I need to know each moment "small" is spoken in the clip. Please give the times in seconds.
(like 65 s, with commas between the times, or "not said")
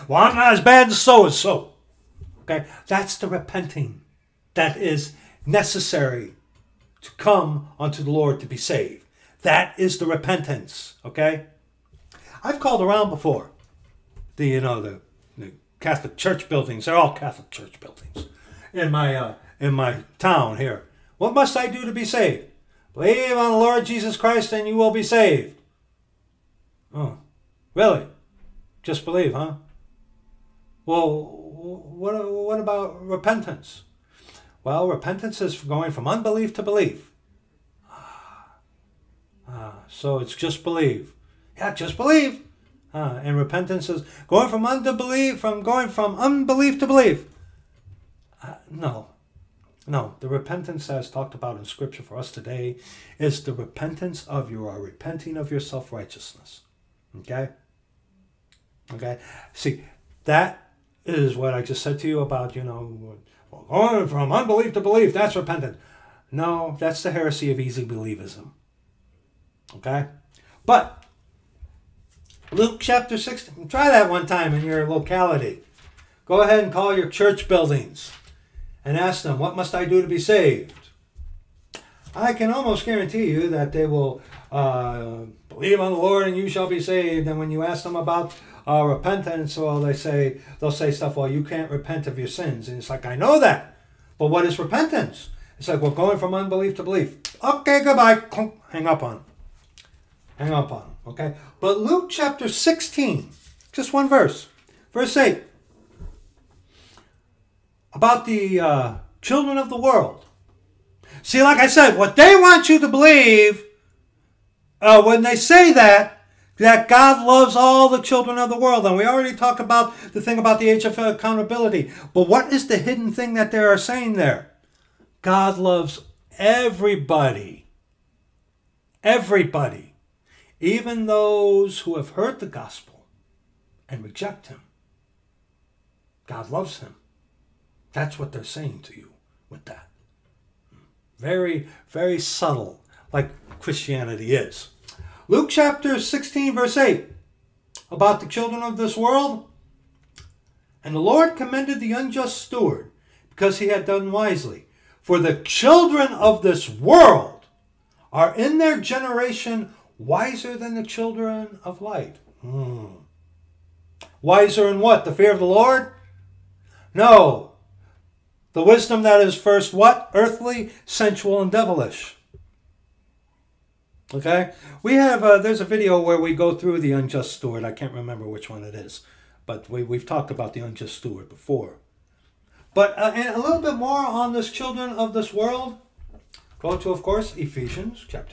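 not said.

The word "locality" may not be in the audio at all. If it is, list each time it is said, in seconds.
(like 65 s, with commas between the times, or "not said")
74 s.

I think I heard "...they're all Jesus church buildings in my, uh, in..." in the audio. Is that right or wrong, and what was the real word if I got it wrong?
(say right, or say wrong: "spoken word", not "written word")
wrong: "Catholic", not "Jesus".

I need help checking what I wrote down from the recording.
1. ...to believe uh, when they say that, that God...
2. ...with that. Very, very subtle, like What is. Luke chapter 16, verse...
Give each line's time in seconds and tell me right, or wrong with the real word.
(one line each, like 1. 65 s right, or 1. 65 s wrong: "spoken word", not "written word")
1. 112 s right
2. 139 s wrong: "Christianity", not "What".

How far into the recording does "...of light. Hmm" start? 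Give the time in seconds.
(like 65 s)
161 s.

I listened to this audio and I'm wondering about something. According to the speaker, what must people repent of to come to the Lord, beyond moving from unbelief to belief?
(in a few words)
Self righteousness.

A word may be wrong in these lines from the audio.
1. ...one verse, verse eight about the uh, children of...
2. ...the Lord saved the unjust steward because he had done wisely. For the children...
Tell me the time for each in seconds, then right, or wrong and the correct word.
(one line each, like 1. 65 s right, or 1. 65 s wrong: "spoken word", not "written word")
1. 103 s right
2. 150 s wrong: "commended", not "saved".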